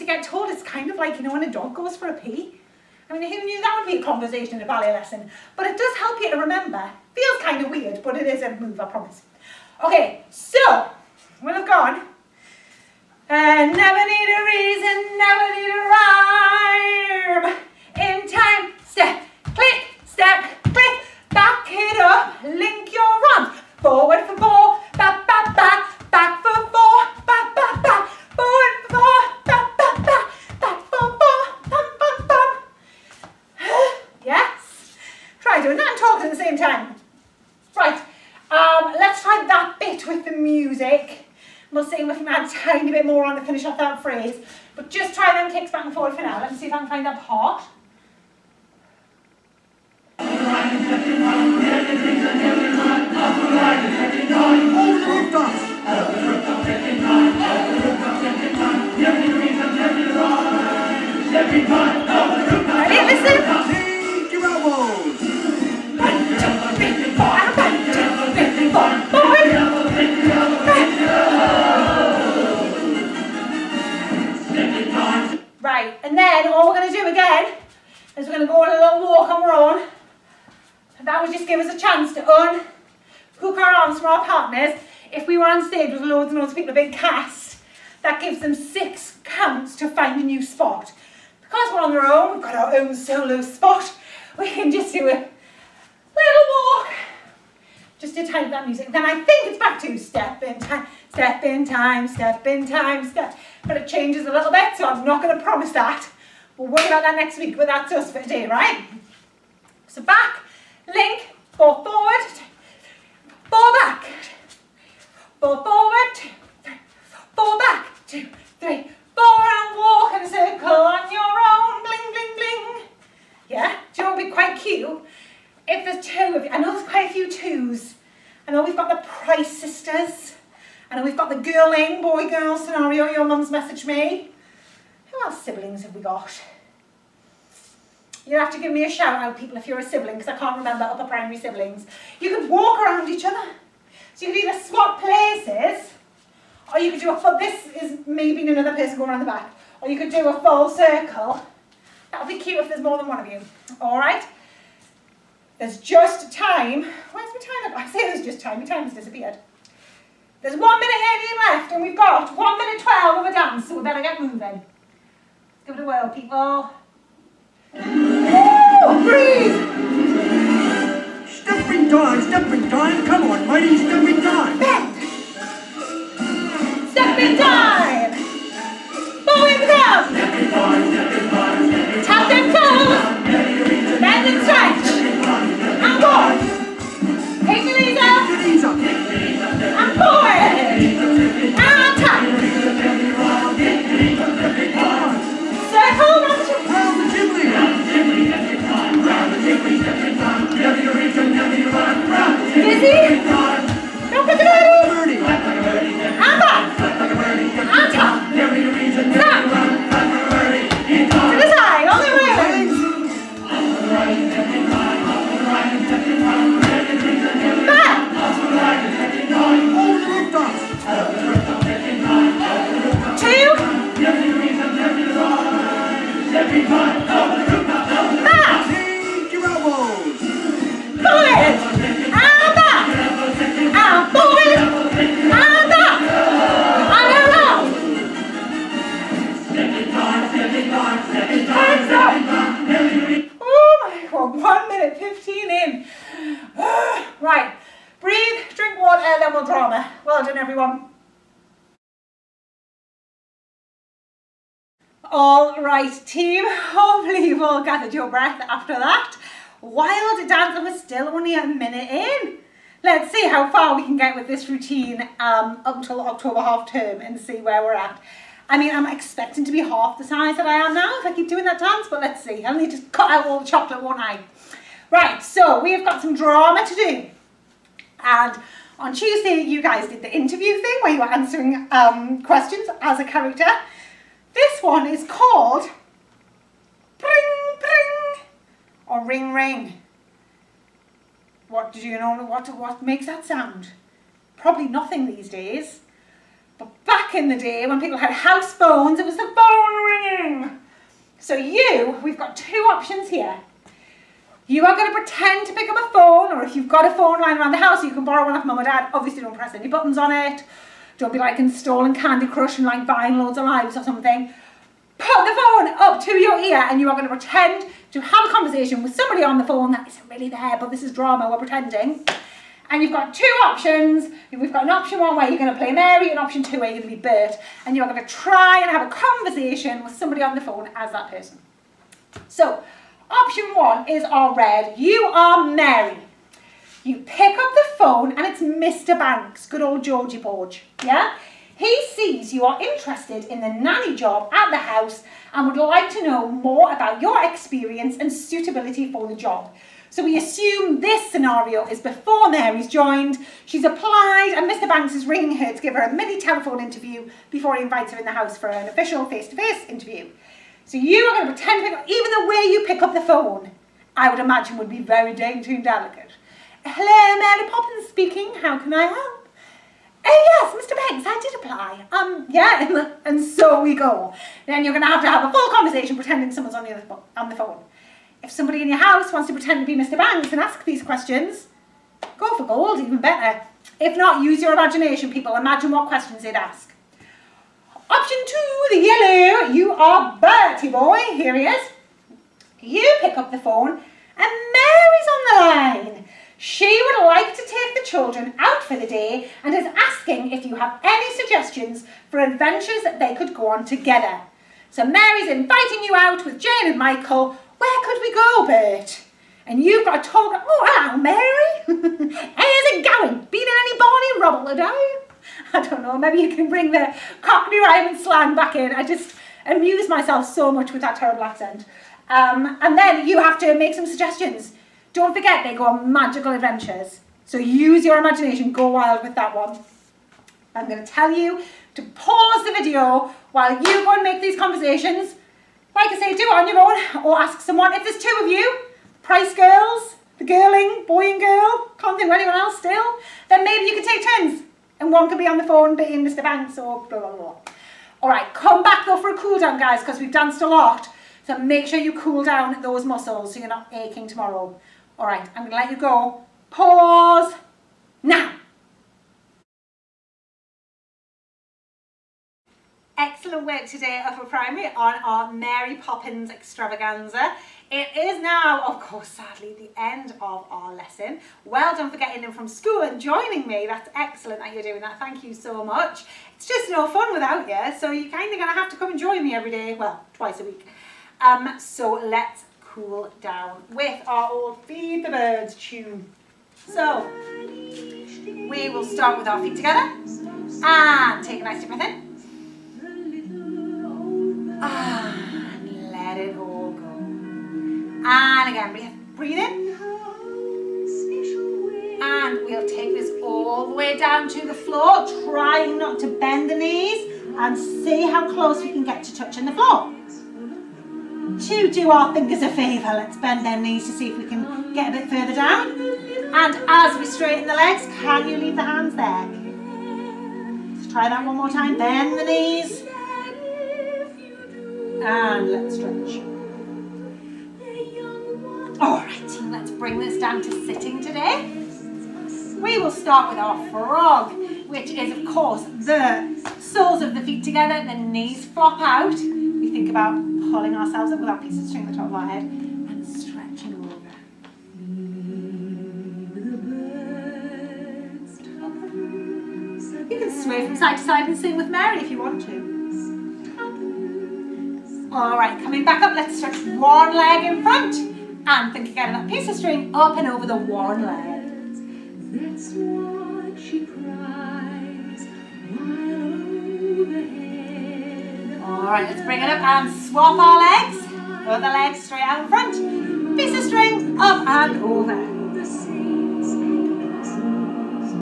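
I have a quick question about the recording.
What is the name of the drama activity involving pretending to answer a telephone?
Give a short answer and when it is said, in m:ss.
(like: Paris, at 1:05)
Pring Pring, at 4:46.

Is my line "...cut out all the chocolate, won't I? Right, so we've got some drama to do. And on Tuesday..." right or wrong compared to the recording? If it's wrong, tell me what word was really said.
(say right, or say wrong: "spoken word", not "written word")
right.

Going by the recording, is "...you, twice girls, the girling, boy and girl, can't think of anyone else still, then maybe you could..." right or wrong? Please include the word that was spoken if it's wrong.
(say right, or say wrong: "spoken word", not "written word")
wrong: "price", not "twice".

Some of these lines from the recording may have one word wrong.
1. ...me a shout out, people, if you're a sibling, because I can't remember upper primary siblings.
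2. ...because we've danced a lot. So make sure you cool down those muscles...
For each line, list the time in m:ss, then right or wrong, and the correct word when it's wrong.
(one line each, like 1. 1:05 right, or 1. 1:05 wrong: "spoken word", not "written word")
1. 2:18 right
2. 7:29 right.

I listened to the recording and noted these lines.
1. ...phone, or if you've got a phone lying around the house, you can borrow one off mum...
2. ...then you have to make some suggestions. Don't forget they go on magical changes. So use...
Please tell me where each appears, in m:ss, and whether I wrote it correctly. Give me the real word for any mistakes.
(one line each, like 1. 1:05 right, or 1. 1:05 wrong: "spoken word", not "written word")
1. 5:05 right
2. 7:02 wrong: "adventures", not "changes".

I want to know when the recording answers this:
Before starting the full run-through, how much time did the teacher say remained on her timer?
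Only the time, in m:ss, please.
2:40.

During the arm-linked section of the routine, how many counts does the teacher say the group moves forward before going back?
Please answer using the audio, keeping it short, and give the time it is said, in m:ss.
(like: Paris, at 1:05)
4, at 0:23.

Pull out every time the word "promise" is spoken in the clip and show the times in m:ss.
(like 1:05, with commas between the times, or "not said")
0:08, 1:45.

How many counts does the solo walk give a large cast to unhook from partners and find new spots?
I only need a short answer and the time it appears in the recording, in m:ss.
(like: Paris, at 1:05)
6, at 1:28.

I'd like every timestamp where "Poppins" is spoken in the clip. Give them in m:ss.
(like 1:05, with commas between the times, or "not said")
6:07, 7:45.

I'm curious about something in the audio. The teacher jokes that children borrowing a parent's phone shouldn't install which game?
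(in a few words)
Candy Crush.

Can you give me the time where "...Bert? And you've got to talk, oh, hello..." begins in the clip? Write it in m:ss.
6:48.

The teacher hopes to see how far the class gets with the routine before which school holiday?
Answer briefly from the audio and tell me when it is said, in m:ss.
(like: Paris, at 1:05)
October half term, at 4:25.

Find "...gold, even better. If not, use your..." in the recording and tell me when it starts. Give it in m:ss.
6:22.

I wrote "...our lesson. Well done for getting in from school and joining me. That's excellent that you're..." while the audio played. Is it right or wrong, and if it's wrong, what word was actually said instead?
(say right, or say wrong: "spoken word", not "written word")
right.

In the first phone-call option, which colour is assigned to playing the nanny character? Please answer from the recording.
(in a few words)
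red.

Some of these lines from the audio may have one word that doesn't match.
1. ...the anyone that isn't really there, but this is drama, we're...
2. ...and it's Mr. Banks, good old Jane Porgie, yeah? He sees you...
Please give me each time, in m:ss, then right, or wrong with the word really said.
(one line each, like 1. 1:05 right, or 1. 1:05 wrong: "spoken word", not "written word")
1. 5:19 wrong: "phone", not "anyone"
2. 5:38 wrong: "Georgie", not "Jane".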